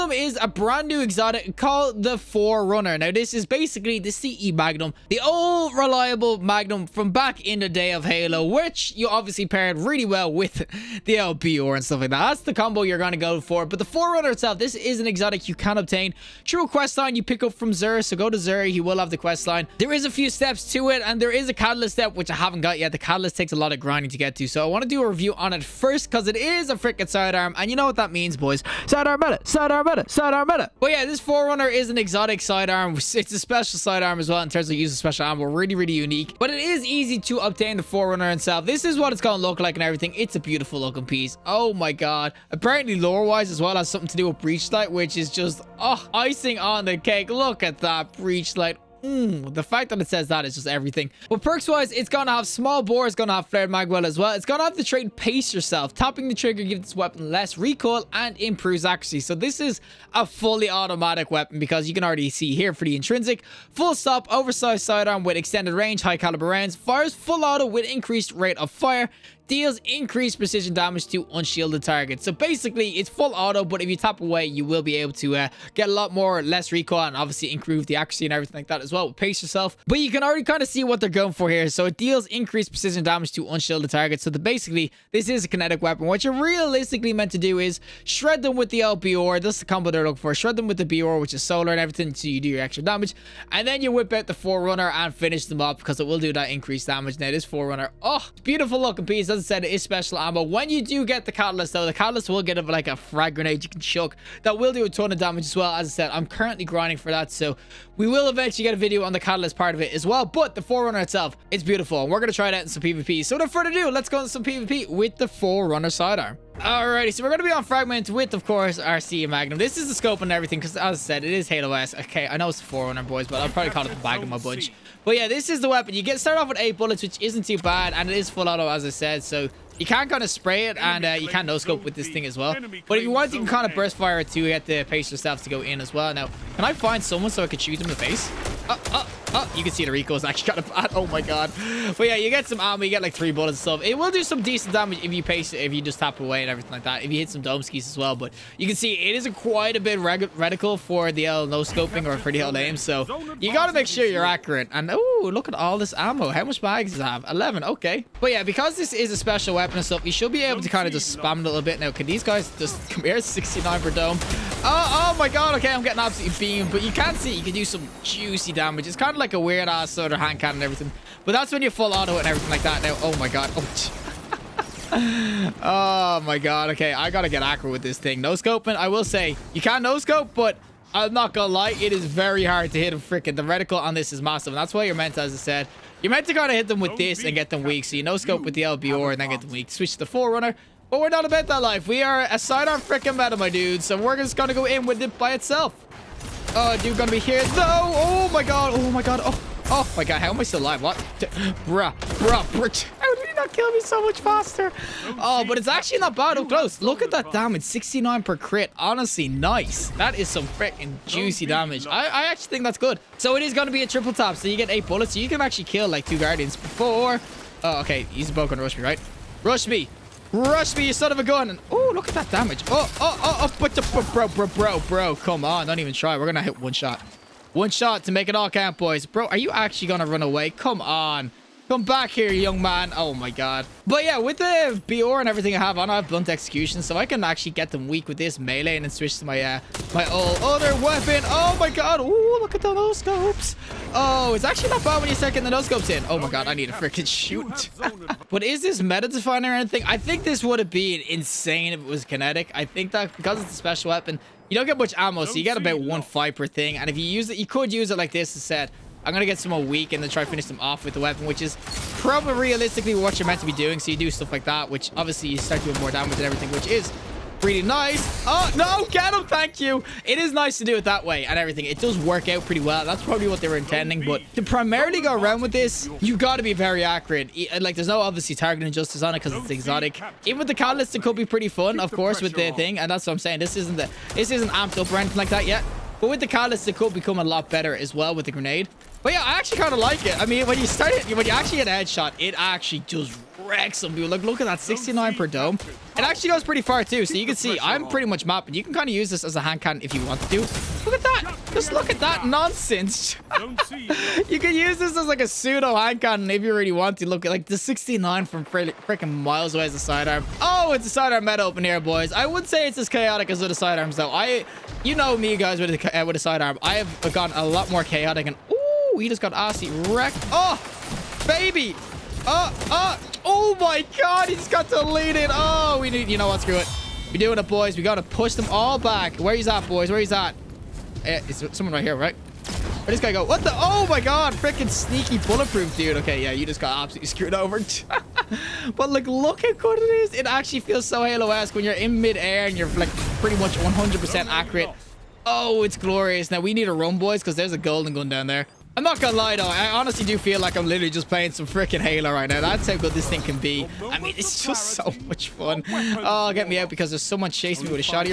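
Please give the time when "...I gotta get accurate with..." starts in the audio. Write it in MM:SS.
02:56.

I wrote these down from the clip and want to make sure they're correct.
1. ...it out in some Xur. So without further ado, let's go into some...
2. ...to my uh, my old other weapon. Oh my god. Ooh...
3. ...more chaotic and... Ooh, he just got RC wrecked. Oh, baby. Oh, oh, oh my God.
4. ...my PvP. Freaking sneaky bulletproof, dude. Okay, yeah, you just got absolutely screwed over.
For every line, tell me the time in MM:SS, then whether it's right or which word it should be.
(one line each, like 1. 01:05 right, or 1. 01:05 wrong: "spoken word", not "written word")
1. 01:52 wrong: "PvP", not "Xur"
2. 03:59 right
3. 05:17 right
4. 05:33 wrong: "God", not "PvP".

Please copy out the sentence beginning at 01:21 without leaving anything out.
So it deals increased precision damage to unshielded targets.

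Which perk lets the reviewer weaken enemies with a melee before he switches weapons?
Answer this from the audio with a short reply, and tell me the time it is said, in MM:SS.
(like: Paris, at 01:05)
Blunt Execution, at 03:56.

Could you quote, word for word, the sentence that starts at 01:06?
Fires full auto with increased rate of fire deals increased precision damage to unshielded targets.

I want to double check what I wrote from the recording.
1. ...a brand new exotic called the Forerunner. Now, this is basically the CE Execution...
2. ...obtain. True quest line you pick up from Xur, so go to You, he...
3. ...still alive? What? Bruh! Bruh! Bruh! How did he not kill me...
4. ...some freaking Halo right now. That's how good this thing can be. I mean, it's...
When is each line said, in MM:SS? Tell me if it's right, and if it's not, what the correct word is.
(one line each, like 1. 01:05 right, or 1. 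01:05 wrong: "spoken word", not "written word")
1. 00:00 wrong: "Magnum", not "Execution"
2. 00:15 wrong: "Xur", not "You"
3. 03:20 right
4. 05:51 right.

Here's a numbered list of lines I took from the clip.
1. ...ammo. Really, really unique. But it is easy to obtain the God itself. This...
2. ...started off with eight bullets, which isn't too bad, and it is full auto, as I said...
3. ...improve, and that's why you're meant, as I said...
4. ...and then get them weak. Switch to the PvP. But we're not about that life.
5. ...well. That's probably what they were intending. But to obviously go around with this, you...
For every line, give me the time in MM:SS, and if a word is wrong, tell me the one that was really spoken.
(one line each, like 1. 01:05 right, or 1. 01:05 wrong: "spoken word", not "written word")
1. 00:35 wrong: "Forerunner", not "God"
2. 02:06 right
3. 03:04 wrong: "massive", not "improve"
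4. 03:09 wrong: "Forerunner", not "PvP"
5. 04:32 wrong: "primarily", not "obviously".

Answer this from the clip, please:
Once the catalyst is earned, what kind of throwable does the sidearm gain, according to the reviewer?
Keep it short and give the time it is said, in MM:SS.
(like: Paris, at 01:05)
frag grenade, at 01:42.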